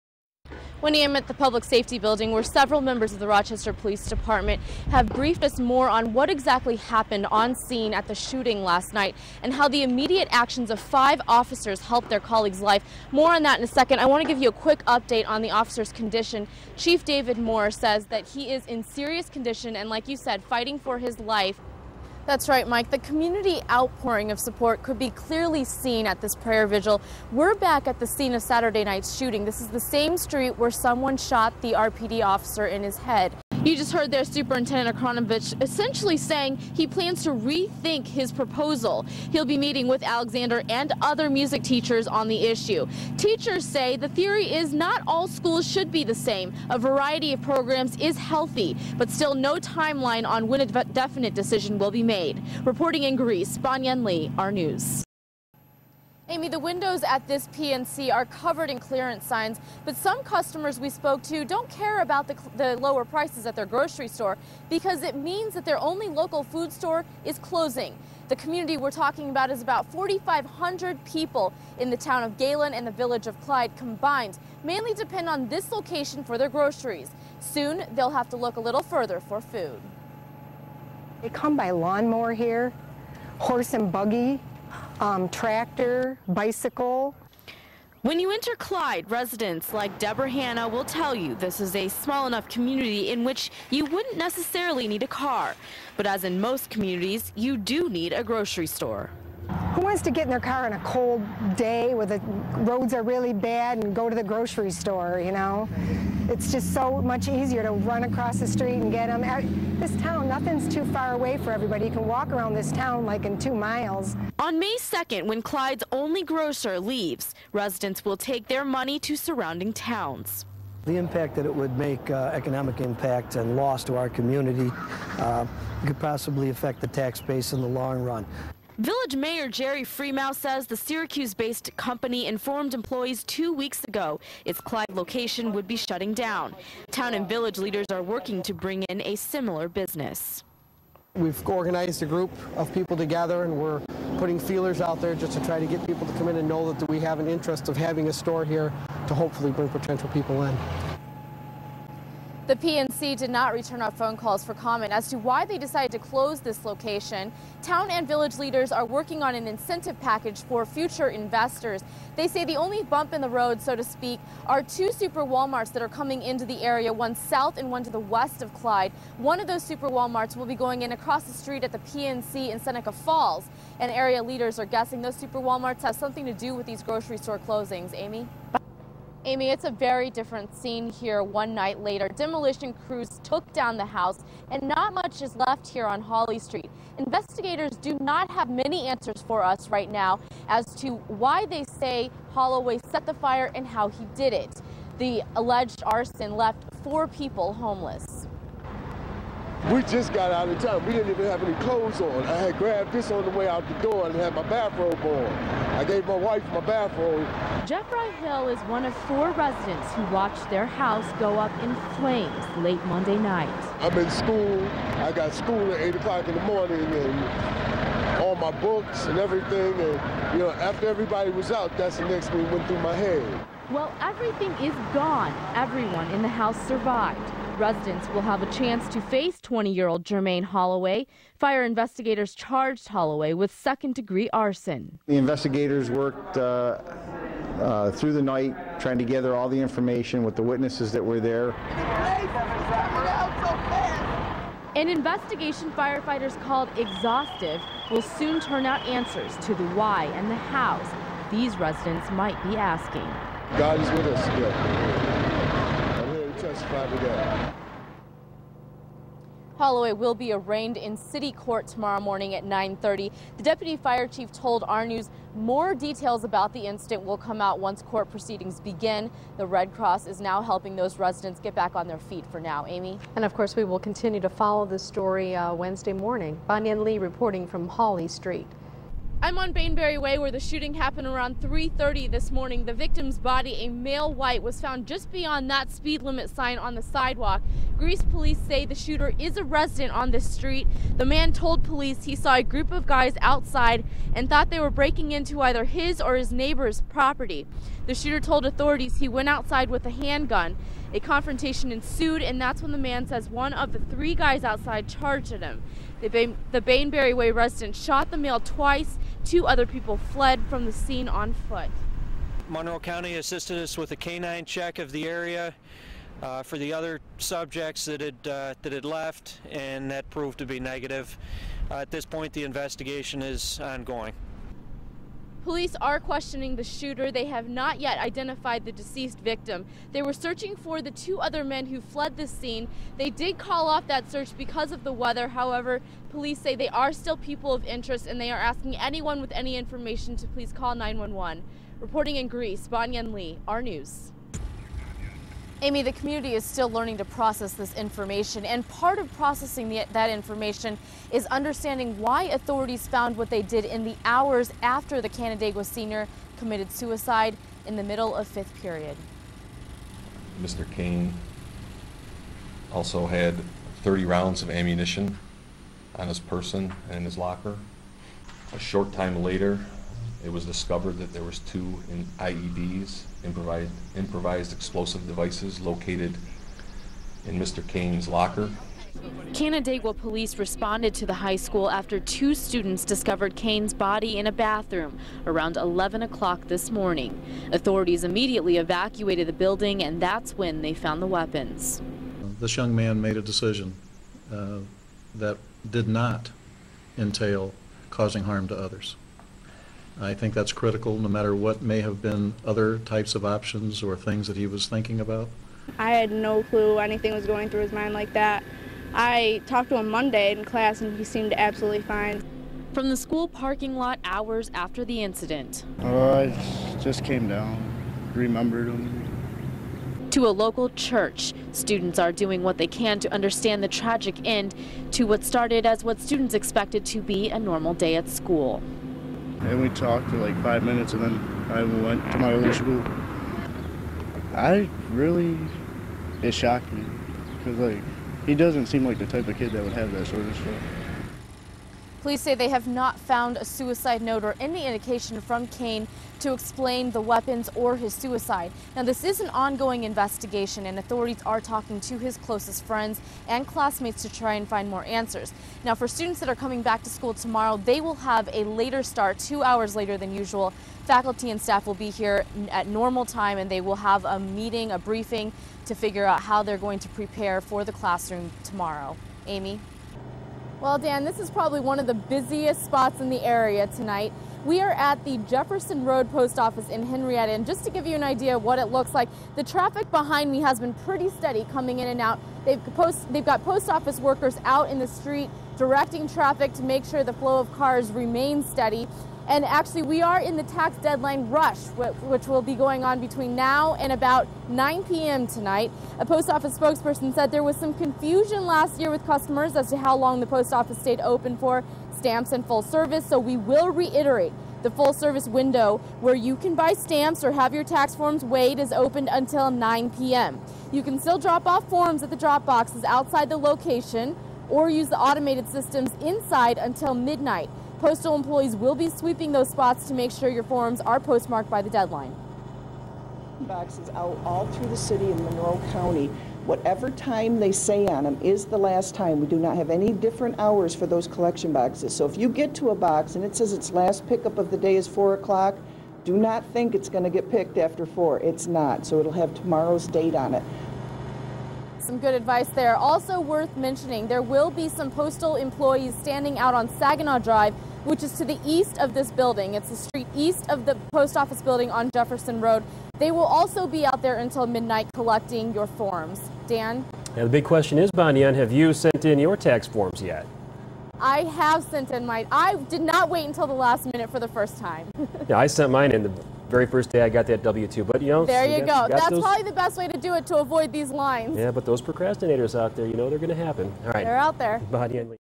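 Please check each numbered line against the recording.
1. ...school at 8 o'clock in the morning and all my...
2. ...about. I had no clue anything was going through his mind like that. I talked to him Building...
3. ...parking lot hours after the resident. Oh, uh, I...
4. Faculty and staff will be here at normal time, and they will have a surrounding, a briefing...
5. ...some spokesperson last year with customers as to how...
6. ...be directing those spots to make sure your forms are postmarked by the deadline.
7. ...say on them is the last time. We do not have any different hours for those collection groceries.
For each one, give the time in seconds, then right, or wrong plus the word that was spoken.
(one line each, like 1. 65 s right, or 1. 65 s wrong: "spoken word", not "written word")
1. 215 s right
2. 404 s wrong: "Monday", not "Building"
3. 413 s wrong: "incident", not "resident"
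4. 460 s wrong: "meeting", not "surrounding"
5. 497 s wrong: "confusion", not "spokesperson"
6. 518 s wrong: "sweeping", not "directing"
7. 527 s wrong: "boxes", not "groceries".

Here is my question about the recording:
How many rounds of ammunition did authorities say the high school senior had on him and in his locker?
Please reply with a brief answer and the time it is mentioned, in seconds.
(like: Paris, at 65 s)
30, at 363 s.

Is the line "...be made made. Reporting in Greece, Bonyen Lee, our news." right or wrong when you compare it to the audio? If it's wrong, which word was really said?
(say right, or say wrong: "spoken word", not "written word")
right.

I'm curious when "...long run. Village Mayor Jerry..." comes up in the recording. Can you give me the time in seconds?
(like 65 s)
127 s.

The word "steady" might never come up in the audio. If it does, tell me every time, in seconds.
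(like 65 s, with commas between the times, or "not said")
481 s, 488 s.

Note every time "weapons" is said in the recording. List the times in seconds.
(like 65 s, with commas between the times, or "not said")
391 s, 447 s.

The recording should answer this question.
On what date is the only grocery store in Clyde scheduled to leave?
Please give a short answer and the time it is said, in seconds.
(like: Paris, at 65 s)
May 2nd, at 114 s.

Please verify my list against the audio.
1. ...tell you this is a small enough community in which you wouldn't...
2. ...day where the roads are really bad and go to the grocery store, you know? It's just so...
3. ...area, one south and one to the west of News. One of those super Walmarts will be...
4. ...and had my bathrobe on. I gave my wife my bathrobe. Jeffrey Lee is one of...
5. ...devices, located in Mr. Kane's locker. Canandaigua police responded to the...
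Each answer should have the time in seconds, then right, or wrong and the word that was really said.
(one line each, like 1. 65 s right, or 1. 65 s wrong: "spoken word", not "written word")
1. 90 s right
2. 101 s right
3. 166 s wrong: "Clyde", not "News"
4. 204 s wrong: "Hill", not "Lee"
5. 375 s right.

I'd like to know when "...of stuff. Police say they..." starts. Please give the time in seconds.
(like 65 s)
440 s.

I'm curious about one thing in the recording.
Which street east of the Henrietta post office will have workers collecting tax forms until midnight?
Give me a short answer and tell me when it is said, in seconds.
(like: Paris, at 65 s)
Saginaw Drive, at 546 s.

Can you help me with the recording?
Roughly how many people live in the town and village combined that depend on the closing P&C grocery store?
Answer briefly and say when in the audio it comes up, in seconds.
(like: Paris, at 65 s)
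4,500, at 69 s.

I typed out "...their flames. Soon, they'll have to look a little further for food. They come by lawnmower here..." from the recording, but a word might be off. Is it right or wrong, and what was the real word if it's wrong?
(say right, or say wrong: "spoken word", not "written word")
wrong: "groceries", not "flames".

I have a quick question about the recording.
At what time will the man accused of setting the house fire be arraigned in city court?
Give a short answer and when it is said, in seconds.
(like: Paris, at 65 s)
9:30, at 262 s.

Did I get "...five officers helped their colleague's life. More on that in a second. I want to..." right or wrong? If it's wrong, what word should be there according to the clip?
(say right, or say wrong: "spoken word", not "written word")
right.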